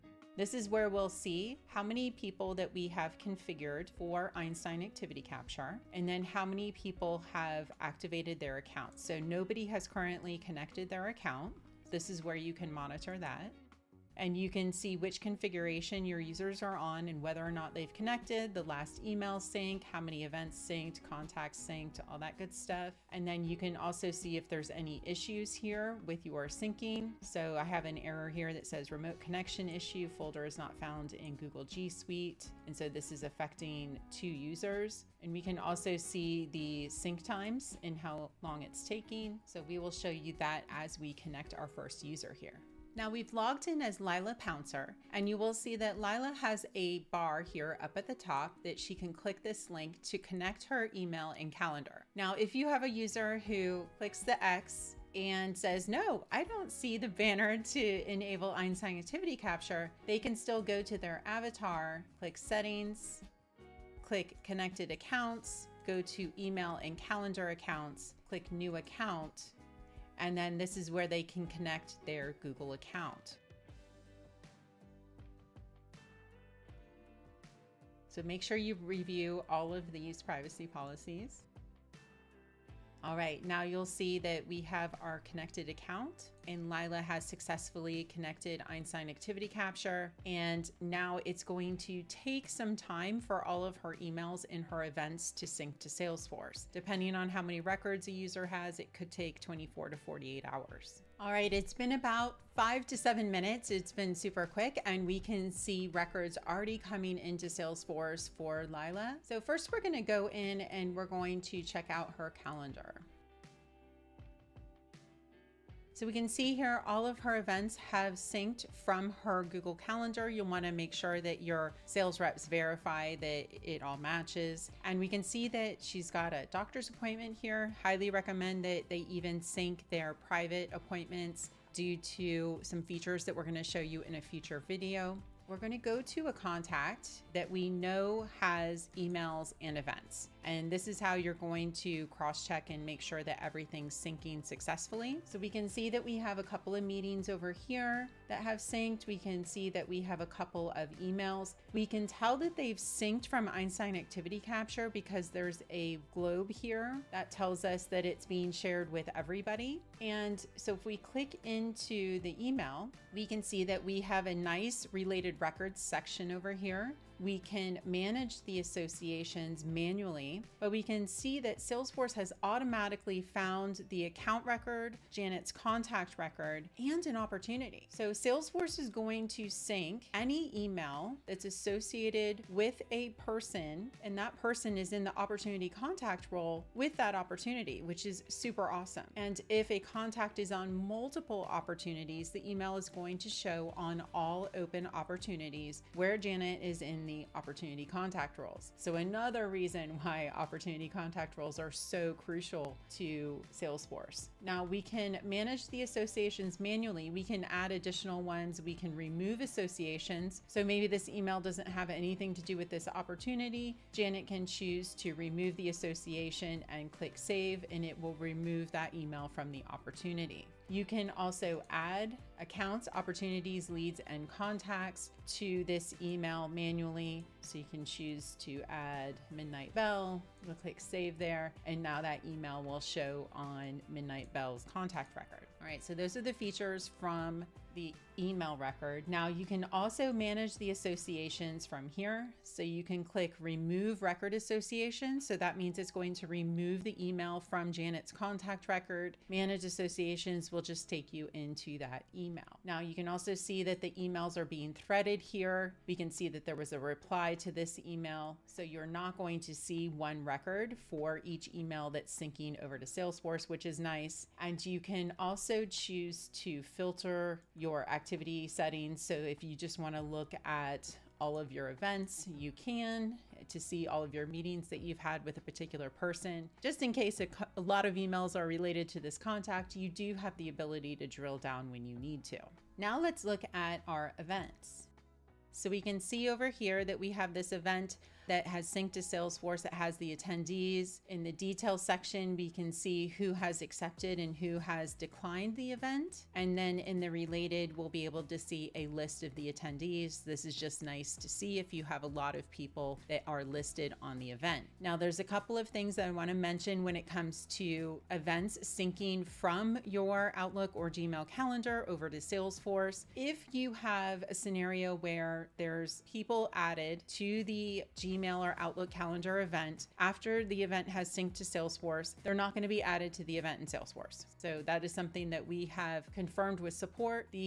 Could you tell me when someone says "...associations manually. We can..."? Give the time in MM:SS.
03:25.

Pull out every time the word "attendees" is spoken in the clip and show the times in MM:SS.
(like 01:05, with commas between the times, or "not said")
04:50, 04:59.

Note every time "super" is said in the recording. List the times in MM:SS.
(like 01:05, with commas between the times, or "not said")
01:44, 03:08.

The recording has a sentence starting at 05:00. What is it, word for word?
This is just nice to see if you have a lot of people that are listed on the event.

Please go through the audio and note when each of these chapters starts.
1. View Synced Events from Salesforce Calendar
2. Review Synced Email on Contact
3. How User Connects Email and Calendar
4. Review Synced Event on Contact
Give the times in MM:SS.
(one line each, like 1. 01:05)
1. 01:41
2. 02:16
3. 00:41
4. 04:41.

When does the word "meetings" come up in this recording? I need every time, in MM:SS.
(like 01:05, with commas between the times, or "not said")
02:26, 04:34.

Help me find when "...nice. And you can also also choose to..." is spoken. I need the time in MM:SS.
04:23.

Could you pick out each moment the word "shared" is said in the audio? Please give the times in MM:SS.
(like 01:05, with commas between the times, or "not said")
02:38.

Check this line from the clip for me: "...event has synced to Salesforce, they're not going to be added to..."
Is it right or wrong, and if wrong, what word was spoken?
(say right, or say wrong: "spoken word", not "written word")
right.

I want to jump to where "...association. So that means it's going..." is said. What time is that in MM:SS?
04:04.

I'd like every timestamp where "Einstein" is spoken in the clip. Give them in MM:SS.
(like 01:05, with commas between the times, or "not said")
00:04, 00:58, 01:28, 02:33.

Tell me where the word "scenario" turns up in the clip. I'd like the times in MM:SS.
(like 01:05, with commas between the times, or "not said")
05:14.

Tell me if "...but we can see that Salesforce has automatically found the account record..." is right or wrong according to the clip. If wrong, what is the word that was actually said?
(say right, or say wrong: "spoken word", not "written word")
right.